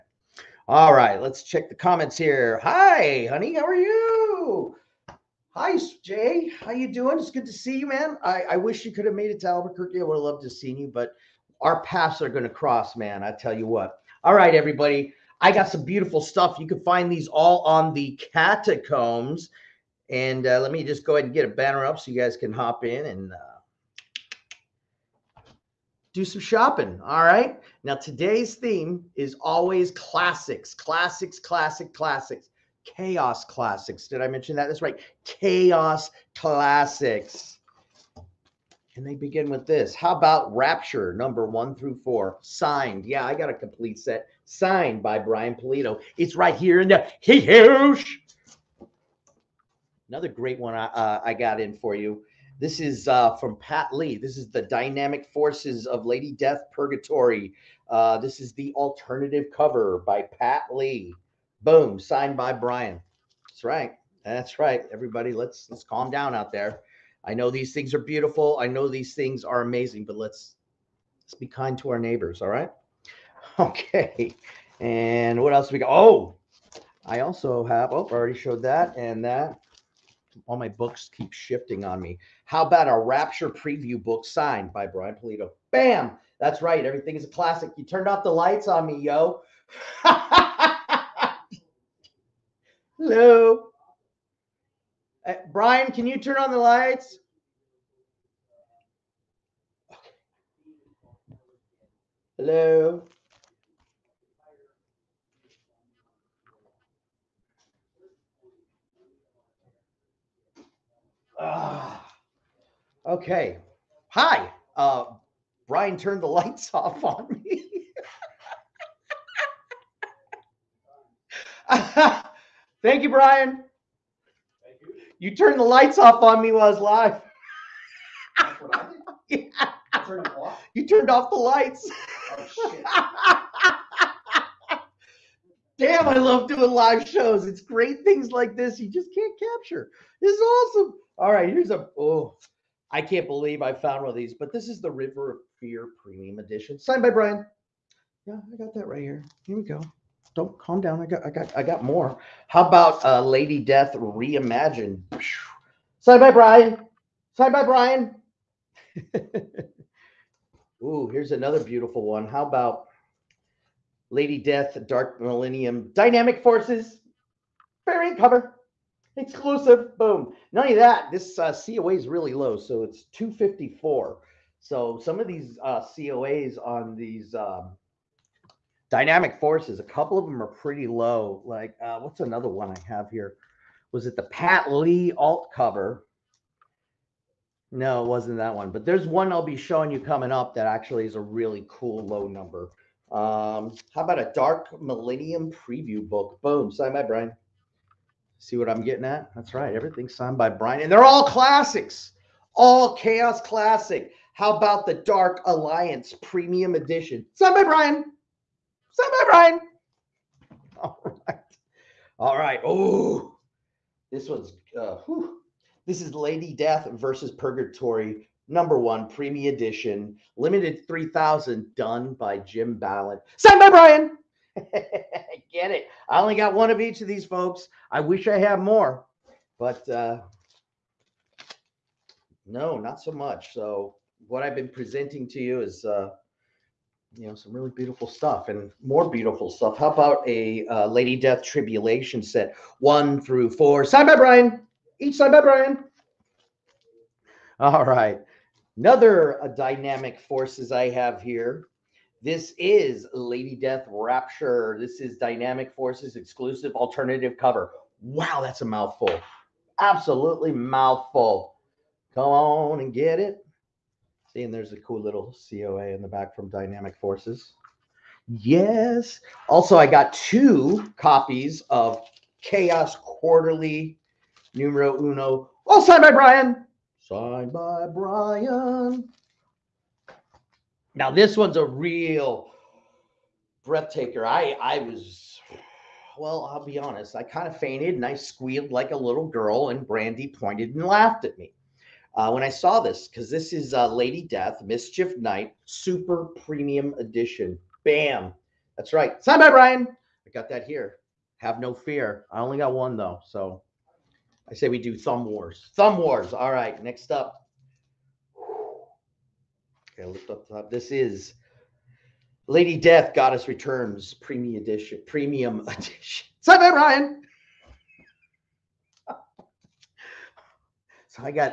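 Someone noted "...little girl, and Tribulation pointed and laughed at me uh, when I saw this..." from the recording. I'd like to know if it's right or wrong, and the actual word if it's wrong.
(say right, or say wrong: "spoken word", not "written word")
wrong: "Brandy", not "Tribulation".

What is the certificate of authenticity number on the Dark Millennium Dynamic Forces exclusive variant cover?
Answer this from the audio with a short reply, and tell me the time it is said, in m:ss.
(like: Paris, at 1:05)
254, at 2:52.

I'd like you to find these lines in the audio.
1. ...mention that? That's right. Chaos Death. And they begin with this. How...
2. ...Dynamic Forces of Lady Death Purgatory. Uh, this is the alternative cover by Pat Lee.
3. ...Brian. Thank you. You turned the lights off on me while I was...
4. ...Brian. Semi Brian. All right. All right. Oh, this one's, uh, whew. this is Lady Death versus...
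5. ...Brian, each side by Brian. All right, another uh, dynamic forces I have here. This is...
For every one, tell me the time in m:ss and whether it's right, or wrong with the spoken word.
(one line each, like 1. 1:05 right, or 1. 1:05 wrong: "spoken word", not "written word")
1. 0:34 wrong: "Classics", not "Death"
2. 0:54 right
3. 2:03 right
4. 3:27 right
5. 4:04 right.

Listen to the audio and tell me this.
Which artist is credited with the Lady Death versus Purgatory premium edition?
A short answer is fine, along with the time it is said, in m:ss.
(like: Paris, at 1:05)
Jim Balent, at 3:41.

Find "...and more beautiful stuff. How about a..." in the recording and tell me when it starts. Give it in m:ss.
3:58.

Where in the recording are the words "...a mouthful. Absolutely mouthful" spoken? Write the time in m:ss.
4:18.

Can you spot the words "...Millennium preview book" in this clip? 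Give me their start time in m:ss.
3:14.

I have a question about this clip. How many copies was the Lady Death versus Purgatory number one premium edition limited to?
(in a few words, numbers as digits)
3,000.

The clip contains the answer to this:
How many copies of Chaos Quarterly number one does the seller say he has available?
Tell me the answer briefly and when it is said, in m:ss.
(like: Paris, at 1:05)
2, at 4:30.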